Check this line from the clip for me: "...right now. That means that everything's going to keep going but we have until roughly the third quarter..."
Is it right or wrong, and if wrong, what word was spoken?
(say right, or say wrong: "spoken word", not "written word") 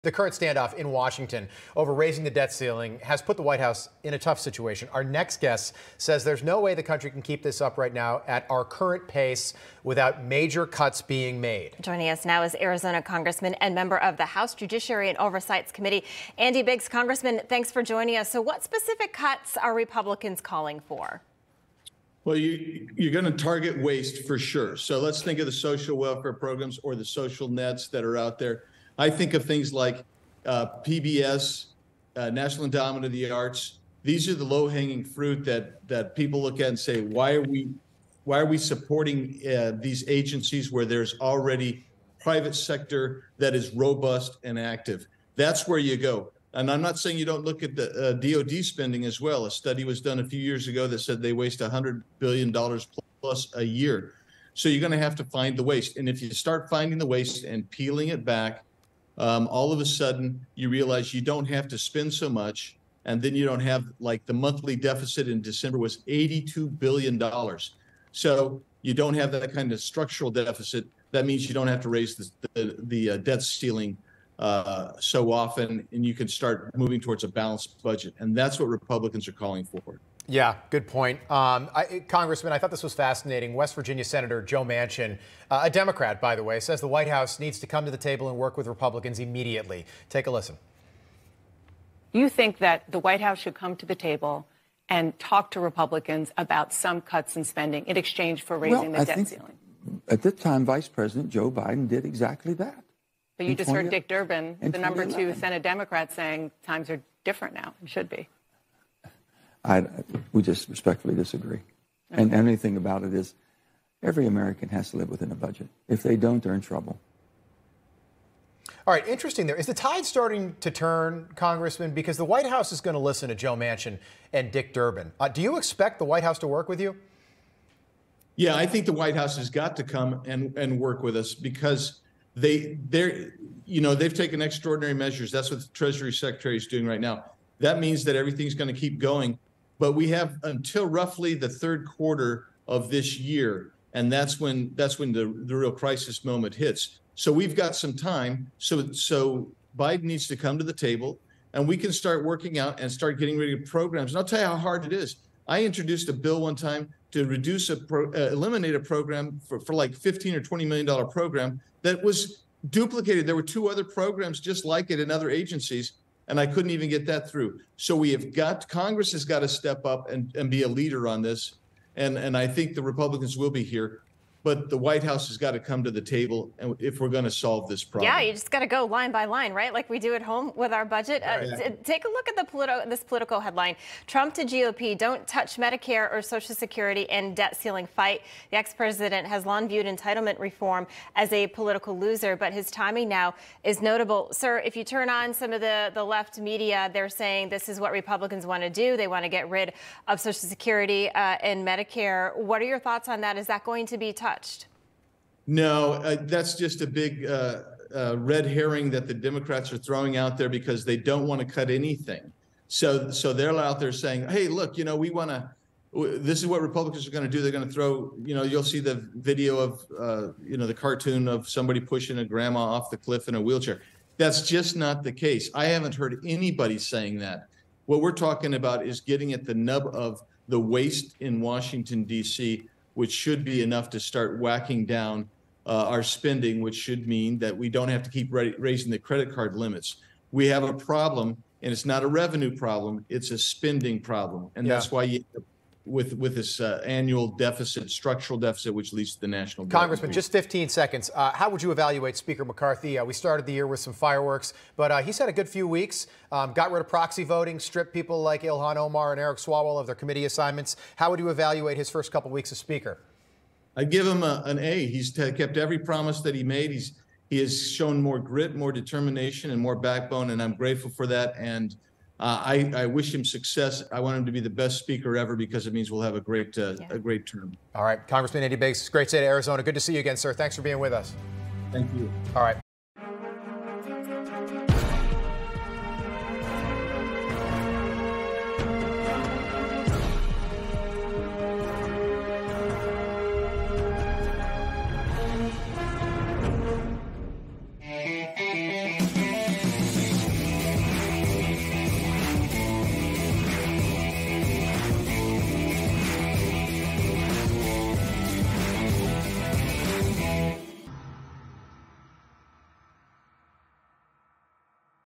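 right.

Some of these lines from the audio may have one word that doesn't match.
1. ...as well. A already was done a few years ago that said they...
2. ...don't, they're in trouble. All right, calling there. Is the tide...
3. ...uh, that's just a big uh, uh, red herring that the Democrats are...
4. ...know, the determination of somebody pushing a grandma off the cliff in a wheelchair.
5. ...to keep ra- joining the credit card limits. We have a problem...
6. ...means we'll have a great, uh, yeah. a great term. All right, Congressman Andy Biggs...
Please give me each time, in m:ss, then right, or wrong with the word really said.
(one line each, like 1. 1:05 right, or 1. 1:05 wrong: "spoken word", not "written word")
1. 0:49 wrong: "study", not "already"
2. 1:56 wrong: "interesting", not "calling"
3. 3:25 right
4. 3:40 wrong: "cartoon", not "determination"
5. 3:58 wrong: "raising", not "joining"
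6. 4:35 right.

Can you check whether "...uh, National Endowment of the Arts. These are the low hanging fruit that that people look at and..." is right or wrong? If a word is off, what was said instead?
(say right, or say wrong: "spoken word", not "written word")
right.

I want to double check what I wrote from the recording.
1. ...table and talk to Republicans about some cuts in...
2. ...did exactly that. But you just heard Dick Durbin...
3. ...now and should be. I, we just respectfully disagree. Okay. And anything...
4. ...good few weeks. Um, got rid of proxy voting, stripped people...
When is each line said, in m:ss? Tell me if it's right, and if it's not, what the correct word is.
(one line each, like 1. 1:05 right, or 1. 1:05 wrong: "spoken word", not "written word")
1. 1:33 right
2. 1:41 right
3. 1:47 right
4. 4:15 right.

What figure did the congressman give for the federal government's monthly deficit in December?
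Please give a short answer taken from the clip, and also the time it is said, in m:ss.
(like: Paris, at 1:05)
$82 billion, at 1:06.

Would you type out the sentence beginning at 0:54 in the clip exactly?
So you're going to have to find the waste.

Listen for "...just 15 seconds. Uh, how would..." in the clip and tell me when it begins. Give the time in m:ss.
4:10.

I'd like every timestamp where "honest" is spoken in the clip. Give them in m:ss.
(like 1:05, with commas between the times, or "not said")
not said.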